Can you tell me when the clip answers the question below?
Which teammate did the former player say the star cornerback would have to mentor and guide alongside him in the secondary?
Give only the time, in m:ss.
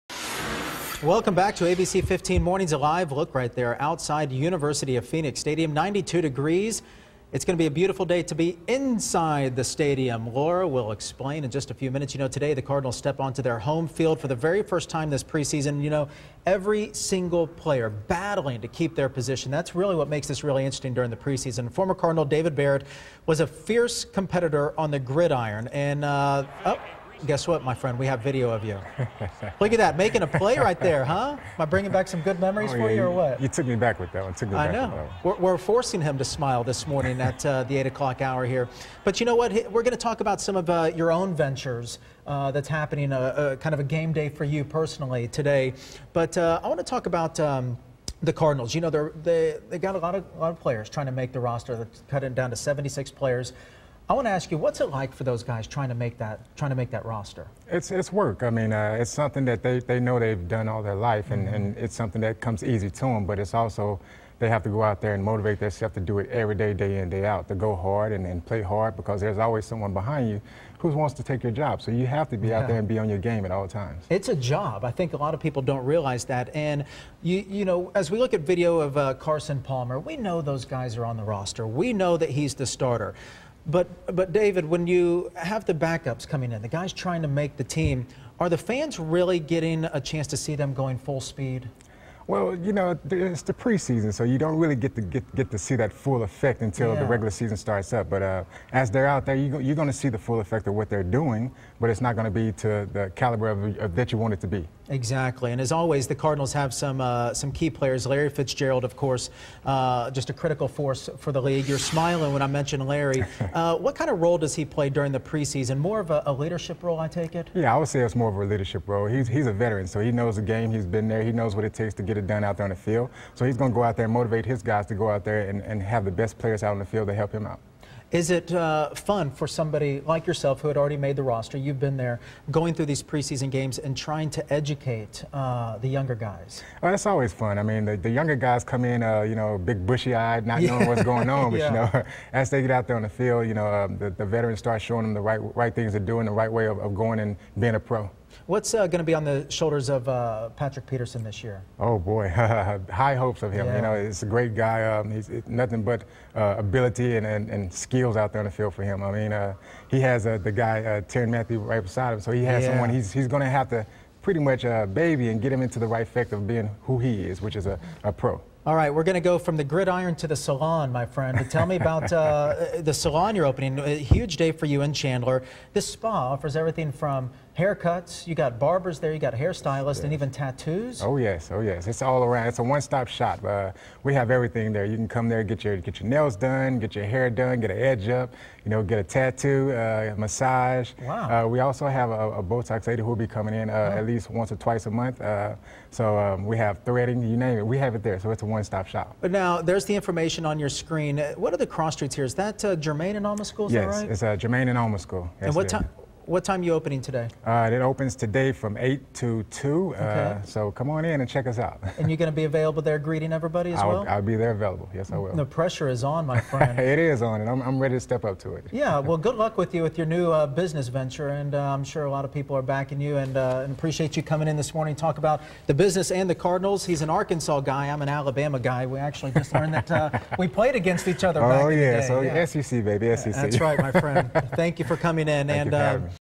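2:41.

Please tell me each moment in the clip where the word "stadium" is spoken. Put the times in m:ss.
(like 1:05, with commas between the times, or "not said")
0:05, 0:09.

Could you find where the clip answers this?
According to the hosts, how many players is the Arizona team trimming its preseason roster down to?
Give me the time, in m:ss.
0:52.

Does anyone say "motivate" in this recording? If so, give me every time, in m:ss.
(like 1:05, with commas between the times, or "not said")
1:05, 2:04.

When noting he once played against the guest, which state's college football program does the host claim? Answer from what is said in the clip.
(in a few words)
Alabama.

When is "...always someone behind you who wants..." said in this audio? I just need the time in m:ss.
1:09.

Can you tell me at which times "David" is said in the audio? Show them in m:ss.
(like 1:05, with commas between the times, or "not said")
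0:22, 1:24.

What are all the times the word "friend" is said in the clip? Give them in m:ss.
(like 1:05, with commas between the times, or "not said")
0:27, 2:51, 3:36, 3:53.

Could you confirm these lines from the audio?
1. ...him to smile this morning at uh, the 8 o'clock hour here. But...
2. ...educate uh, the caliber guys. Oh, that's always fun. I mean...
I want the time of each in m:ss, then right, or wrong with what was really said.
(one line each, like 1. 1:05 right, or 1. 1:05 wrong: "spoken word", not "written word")
1. 0:36 right
2. 2:14 wrong: "younger", not "caliber".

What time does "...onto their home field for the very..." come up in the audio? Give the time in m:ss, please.
0:13.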